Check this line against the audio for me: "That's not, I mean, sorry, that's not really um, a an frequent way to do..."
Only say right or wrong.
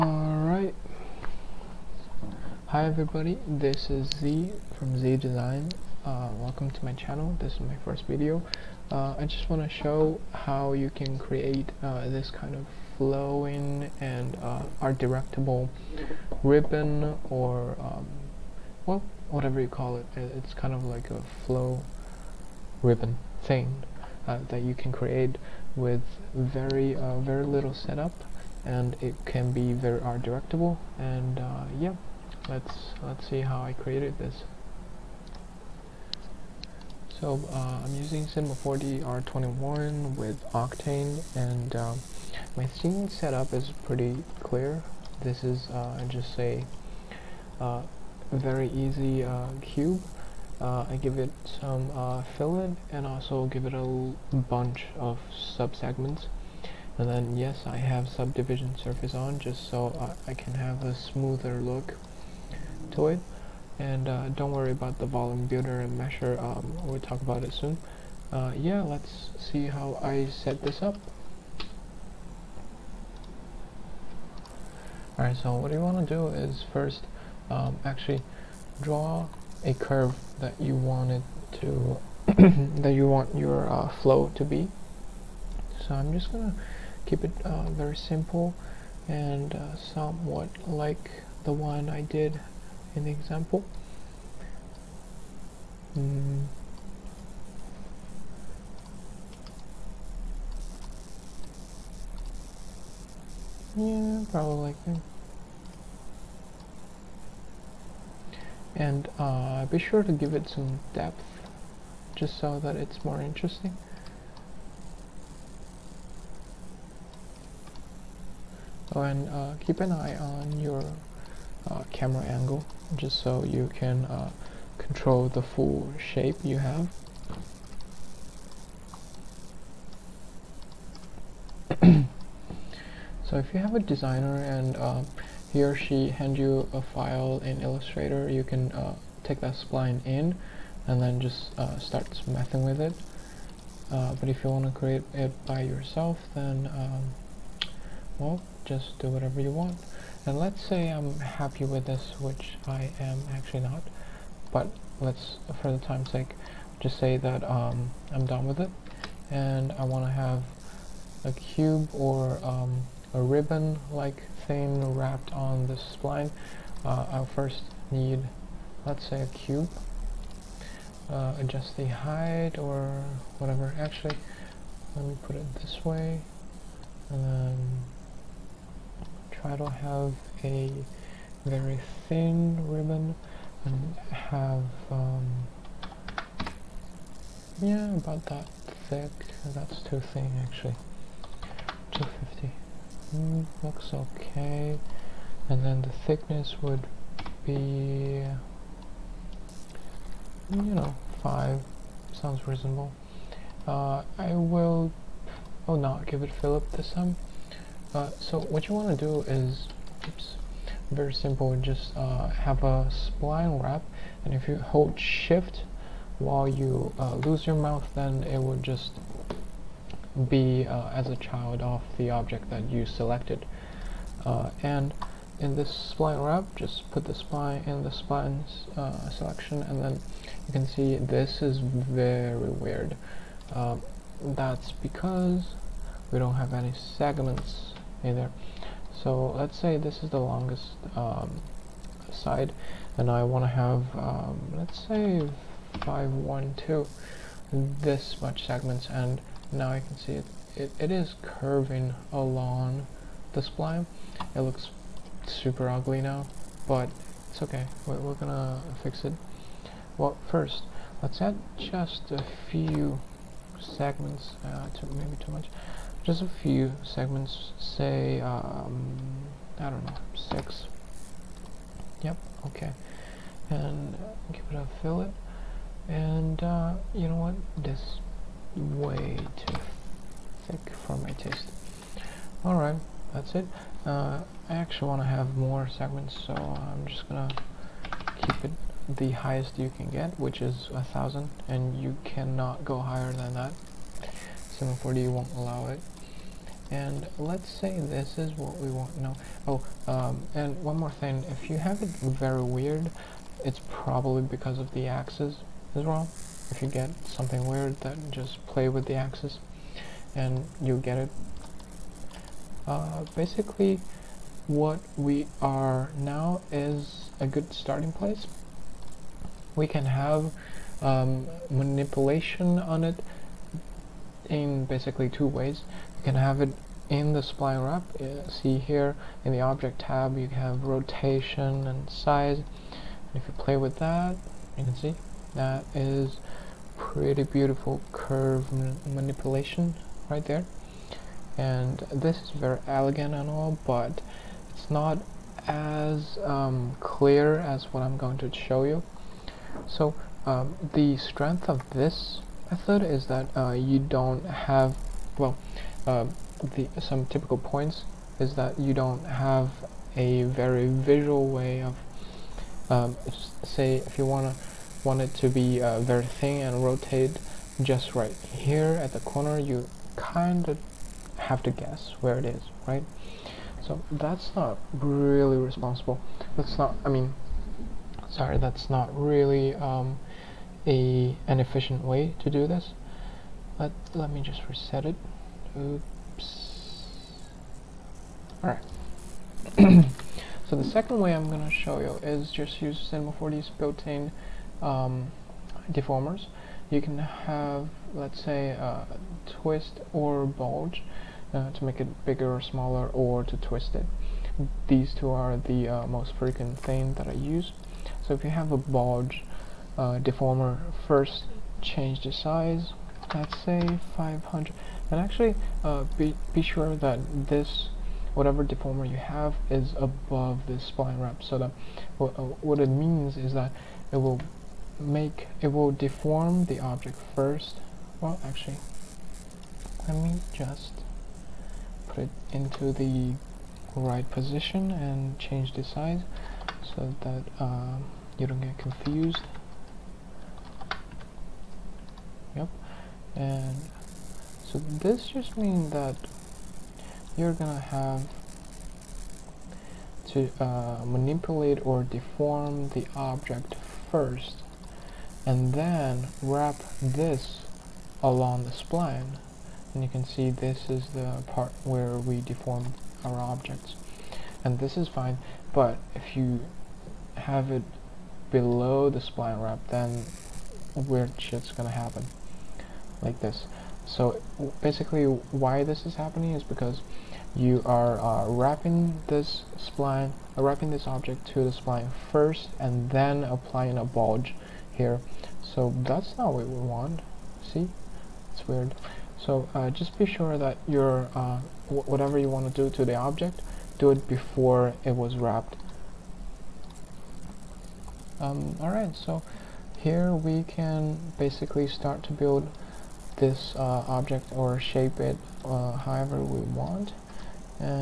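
wrong.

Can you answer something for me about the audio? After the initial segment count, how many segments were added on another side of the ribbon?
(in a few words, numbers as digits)
6.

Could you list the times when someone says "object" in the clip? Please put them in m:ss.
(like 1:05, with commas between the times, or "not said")
3:42, 5:29, 7:06, 7:32, 7:43, 8:00, 8:12, 8:23.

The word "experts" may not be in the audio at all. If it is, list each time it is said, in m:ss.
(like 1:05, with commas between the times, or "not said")
not said.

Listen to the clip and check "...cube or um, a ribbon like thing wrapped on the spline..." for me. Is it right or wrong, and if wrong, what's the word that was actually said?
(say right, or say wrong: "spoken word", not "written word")
right.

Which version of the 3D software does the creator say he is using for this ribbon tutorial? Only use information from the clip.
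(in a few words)
Cinema 4D R21.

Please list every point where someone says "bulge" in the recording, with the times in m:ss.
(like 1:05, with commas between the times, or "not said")
6:40, 6:48, 8:03.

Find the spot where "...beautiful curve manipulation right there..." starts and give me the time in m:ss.
5:37.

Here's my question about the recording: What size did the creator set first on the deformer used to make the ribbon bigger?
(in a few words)
500.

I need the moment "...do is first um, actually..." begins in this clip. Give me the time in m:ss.
1:16.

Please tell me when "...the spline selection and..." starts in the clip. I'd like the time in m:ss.
3:47.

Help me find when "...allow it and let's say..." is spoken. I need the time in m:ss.
4:55.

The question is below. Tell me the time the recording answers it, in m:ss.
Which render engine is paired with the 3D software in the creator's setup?
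0:40.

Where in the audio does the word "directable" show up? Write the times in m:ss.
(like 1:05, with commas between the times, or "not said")
0:14, 0:30.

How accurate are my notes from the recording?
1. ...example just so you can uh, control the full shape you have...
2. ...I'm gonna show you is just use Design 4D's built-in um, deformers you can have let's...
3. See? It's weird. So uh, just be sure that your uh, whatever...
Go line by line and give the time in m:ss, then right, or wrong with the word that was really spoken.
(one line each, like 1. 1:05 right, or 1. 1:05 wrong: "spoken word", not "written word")
1. 2:02 wrong: "angle", not "example"
2. 6:31 wrong: "Cinema", not "Design"
3. 8:07 right.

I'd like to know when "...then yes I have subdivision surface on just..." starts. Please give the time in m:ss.
0:57.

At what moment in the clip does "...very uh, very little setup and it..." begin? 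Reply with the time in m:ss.
0:26.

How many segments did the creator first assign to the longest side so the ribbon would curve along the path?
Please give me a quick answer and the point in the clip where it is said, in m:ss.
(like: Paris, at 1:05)
512, at 4:05.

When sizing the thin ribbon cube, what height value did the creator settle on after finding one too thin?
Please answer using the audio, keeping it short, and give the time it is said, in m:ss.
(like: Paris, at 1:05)
250 mm, at 3:11.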